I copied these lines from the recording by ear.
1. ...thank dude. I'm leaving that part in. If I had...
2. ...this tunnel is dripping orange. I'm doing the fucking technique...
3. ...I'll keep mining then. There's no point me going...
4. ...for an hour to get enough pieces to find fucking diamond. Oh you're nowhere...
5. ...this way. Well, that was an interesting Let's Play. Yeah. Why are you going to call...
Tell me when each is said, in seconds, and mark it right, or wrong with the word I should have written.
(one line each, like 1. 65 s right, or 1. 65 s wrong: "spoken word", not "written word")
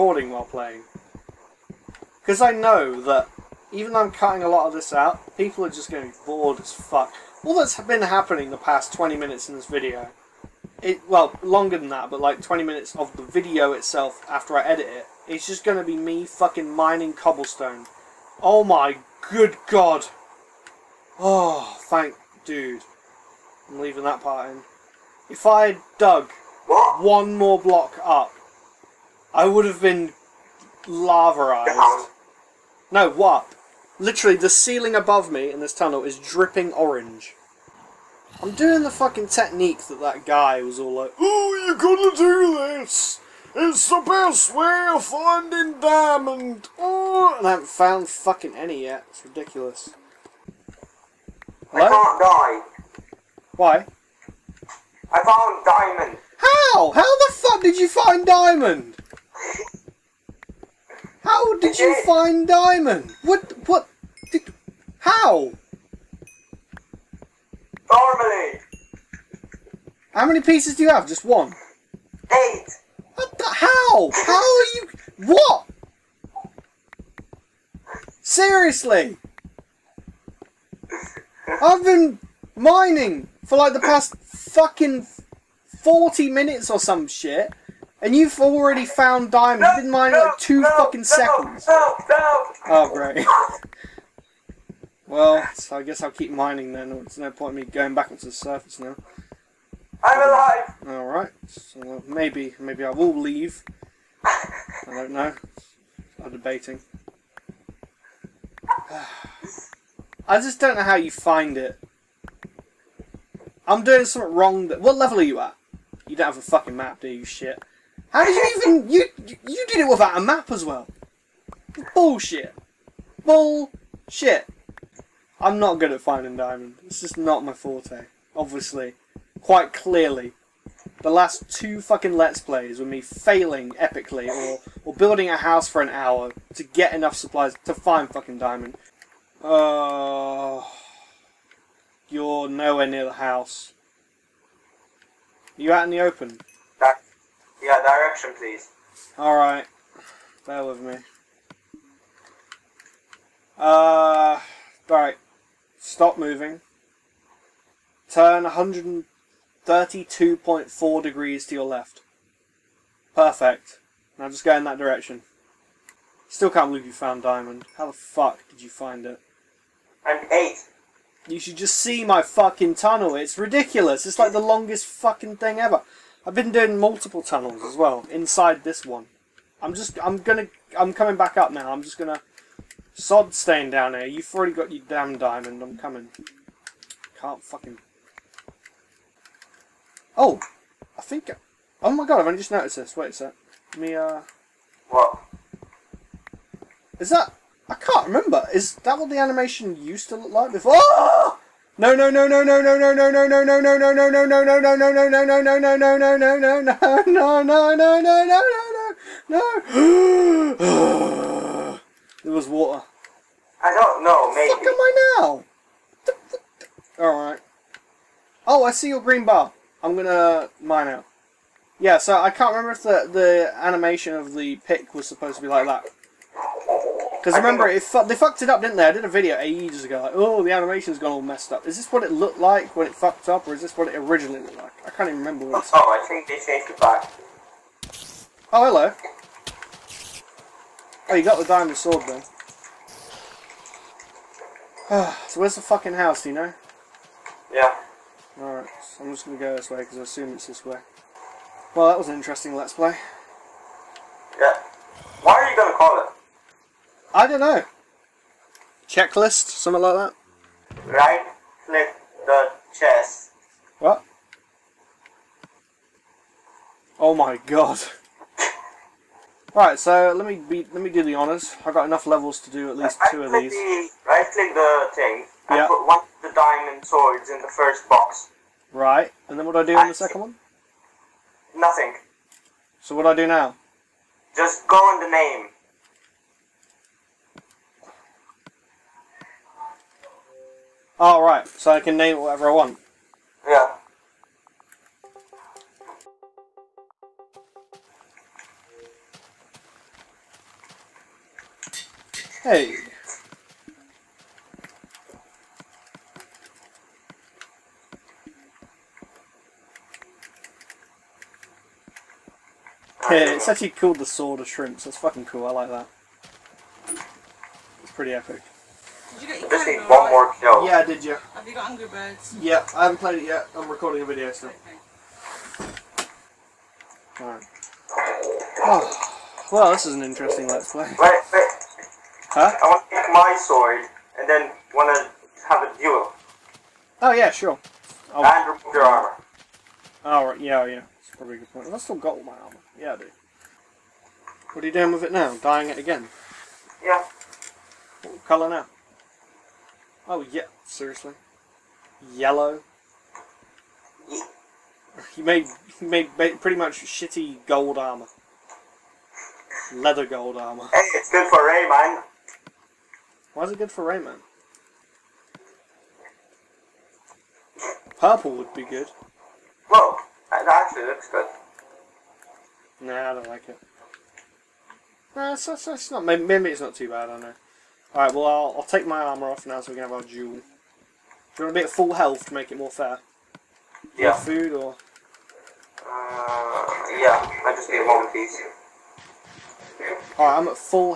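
1. 21 s right
2. 35 s right
3. 96 s right
4. 135 s wrong: "supplies", not "pieces"
5. 250 s right.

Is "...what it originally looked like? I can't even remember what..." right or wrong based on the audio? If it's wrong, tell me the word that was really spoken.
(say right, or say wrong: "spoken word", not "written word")
right.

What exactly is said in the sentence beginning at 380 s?
Do you want to be at full health to make it more fair?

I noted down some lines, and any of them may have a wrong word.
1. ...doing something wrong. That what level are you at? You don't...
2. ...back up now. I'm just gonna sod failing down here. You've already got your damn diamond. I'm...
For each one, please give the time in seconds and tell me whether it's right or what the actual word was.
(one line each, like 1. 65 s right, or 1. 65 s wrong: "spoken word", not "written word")
1. 113 s right
2. 181 s wrong: "staying", not "failing".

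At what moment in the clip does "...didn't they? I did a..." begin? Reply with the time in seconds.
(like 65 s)
228 s.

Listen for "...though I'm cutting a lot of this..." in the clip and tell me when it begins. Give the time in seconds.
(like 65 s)
3 s.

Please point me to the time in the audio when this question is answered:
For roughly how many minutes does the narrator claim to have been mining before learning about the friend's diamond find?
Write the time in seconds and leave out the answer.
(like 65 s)
85 s.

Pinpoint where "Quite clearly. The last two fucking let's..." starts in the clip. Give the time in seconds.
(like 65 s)
129 s.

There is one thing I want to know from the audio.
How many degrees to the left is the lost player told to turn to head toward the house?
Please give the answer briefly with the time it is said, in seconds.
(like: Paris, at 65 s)
132.4, at 158 s.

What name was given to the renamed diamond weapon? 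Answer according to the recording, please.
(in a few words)
Sword of Shrimps.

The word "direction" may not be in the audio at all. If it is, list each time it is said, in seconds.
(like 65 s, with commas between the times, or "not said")
147 s, 164 s.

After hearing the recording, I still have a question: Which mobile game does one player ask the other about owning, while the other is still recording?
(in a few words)
Angry Birds.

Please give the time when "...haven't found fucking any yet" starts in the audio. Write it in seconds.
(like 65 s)
47 s.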